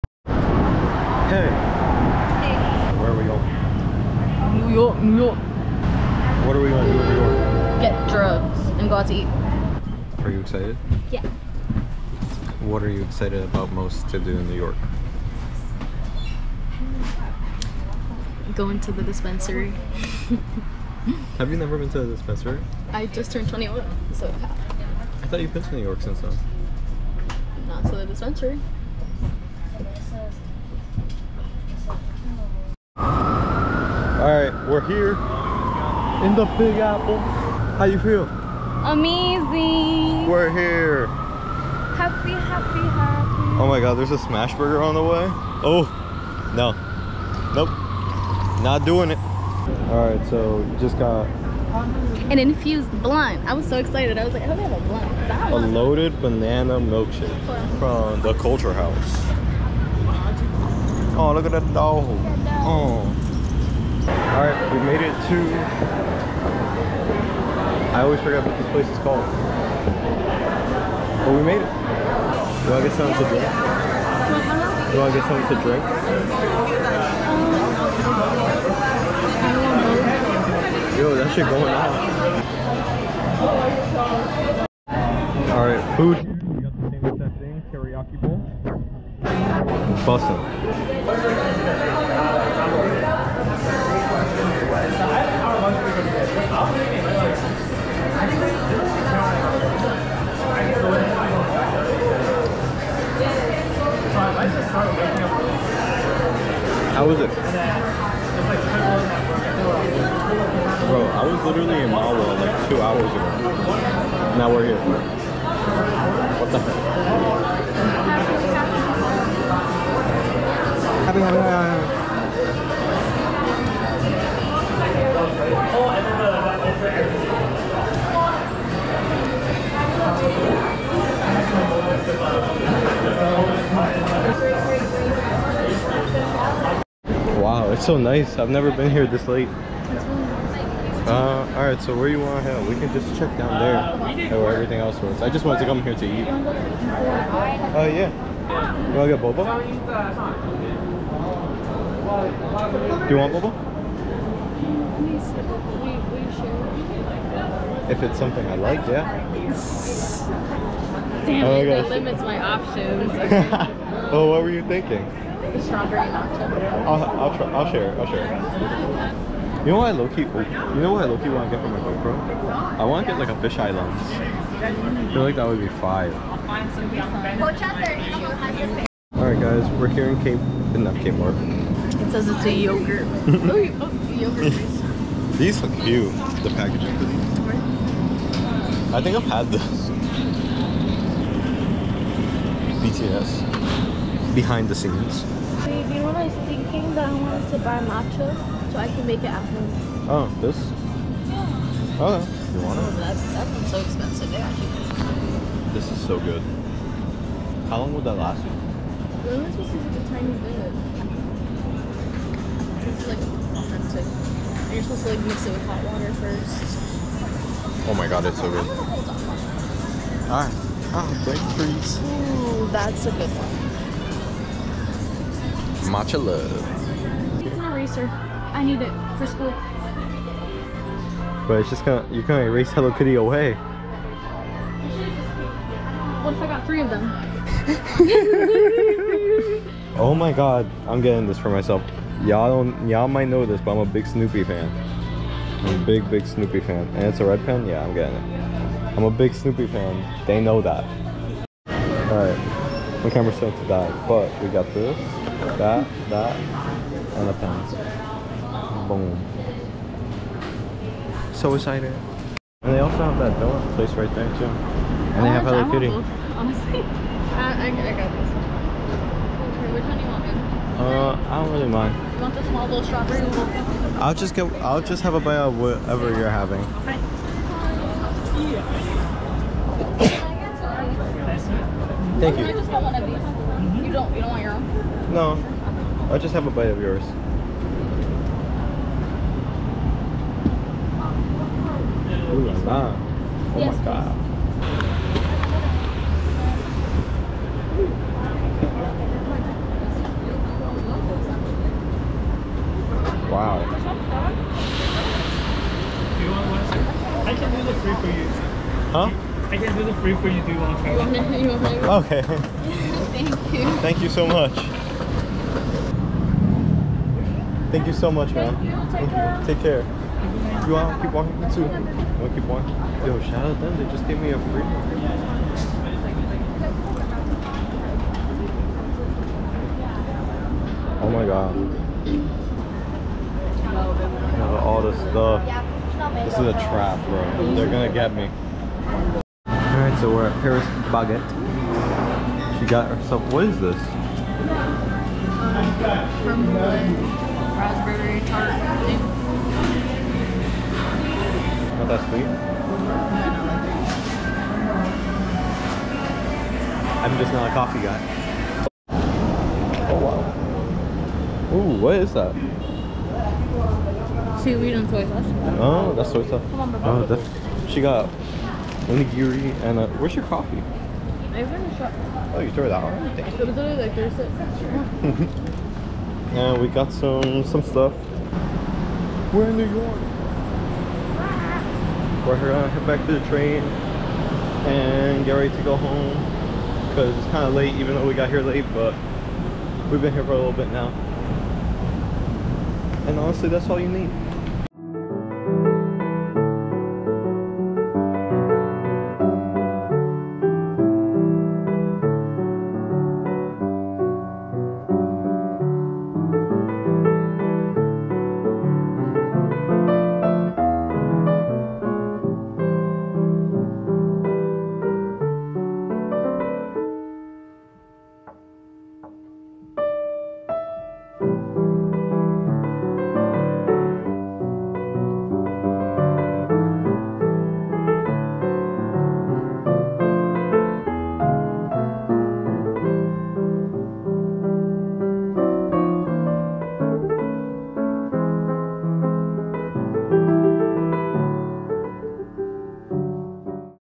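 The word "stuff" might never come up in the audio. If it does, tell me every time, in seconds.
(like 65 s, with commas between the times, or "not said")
334 s, 377 s.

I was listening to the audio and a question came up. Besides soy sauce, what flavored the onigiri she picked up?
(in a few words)
Seaweed.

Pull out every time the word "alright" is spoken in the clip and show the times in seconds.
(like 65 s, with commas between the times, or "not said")
85 s, 141 s, 179 s, 220 s, 251 s, 339 s.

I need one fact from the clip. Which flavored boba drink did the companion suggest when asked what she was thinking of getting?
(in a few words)
Strawberry matcha.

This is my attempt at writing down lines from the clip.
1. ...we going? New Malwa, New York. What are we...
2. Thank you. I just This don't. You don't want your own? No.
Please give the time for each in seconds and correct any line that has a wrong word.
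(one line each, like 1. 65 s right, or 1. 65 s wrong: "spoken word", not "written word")
1. 3 s wrong: "York", not "Malwa"
2. 282 s wrong: "You", not "This".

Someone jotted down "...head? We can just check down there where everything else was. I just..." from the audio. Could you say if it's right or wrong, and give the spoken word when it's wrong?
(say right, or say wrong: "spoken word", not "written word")
right.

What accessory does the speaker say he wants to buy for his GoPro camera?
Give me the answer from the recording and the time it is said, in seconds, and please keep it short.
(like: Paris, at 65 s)
Fisheye lens, at 173 s.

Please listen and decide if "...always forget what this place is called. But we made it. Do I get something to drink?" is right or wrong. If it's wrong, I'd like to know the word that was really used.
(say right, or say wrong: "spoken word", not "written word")
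right.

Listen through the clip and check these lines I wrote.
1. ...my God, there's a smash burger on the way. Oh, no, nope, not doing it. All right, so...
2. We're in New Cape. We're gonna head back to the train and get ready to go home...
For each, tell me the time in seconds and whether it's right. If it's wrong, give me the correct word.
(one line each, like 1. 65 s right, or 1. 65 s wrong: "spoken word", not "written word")
1. 43 s right
2. 379 s wrong: "York", not "Cape".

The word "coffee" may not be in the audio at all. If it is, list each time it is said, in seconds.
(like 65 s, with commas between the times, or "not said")
357 s, 370 s.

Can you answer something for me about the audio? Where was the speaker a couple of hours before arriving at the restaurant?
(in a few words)
Malwa.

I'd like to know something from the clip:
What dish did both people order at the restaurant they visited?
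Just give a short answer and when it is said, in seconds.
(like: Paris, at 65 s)
Teriyaki bowl, at 87 s.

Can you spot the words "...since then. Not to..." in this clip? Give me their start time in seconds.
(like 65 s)
26 s.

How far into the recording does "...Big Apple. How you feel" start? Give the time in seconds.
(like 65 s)
36 s.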